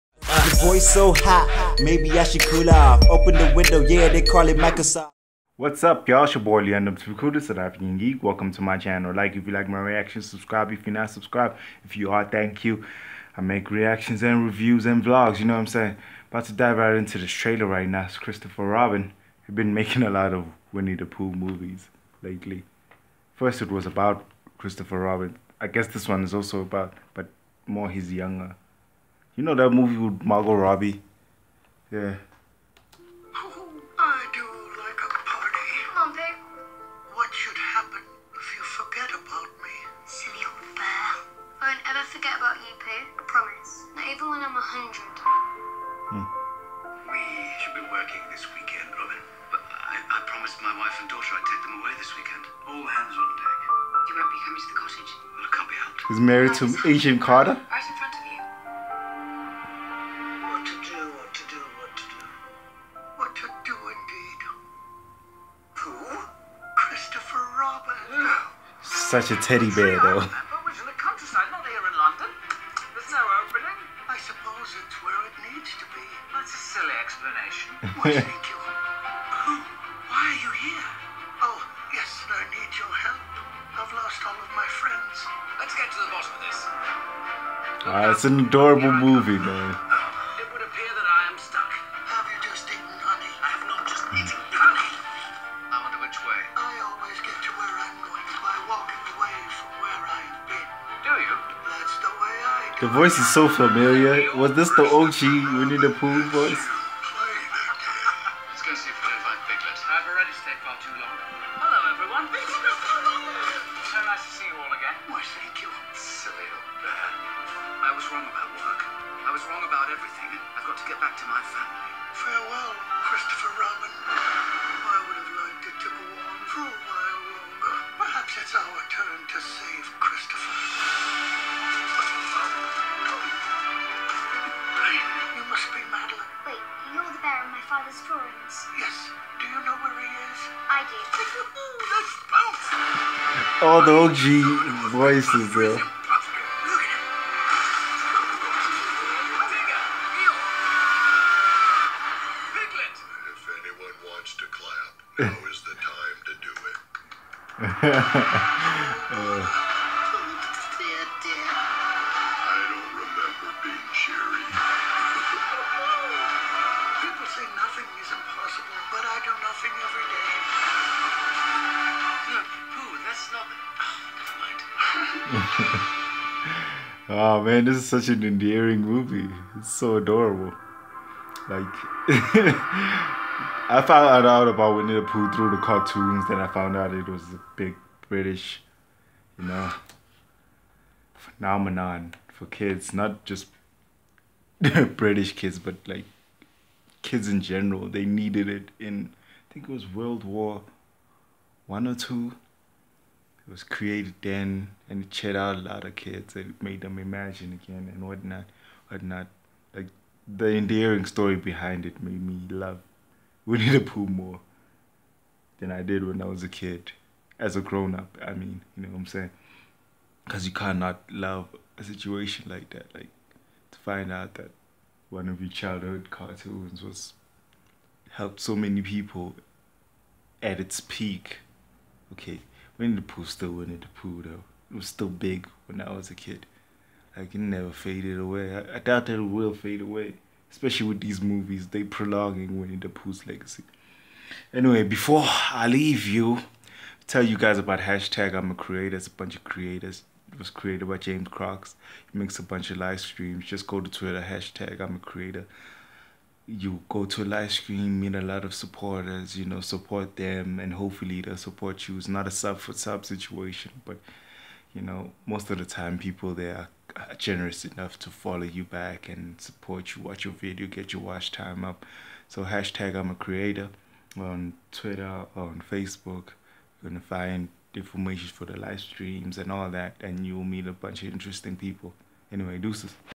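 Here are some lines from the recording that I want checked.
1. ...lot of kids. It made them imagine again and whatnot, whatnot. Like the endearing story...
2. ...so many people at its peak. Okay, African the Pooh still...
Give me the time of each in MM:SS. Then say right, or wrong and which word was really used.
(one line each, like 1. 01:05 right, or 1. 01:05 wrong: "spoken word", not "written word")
1. 03:25 right
2. 03:48 wrong: "Winnie", not "African".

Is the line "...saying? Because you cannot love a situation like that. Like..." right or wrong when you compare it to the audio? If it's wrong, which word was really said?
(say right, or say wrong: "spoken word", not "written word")
right.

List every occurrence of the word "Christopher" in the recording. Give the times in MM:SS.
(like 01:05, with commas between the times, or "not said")
00:18, 00:24.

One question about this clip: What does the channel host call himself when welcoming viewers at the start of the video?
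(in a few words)
South African Geek.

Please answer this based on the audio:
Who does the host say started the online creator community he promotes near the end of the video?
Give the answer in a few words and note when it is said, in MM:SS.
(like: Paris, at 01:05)
James Crocs, at 04:10.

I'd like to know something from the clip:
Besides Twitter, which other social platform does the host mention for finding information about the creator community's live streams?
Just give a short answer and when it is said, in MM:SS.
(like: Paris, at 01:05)
Facebook, at 04:35.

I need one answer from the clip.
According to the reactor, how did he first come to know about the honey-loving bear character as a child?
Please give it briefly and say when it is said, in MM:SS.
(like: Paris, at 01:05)
Through the cartoons, at 03:05.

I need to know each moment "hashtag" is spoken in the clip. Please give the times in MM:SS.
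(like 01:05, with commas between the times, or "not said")
04:07, 04:14, 04:32.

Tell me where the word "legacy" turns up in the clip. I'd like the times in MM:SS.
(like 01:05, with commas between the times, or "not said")
04:03.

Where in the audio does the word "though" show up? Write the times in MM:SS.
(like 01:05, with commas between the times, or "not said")
01:09, 03:54.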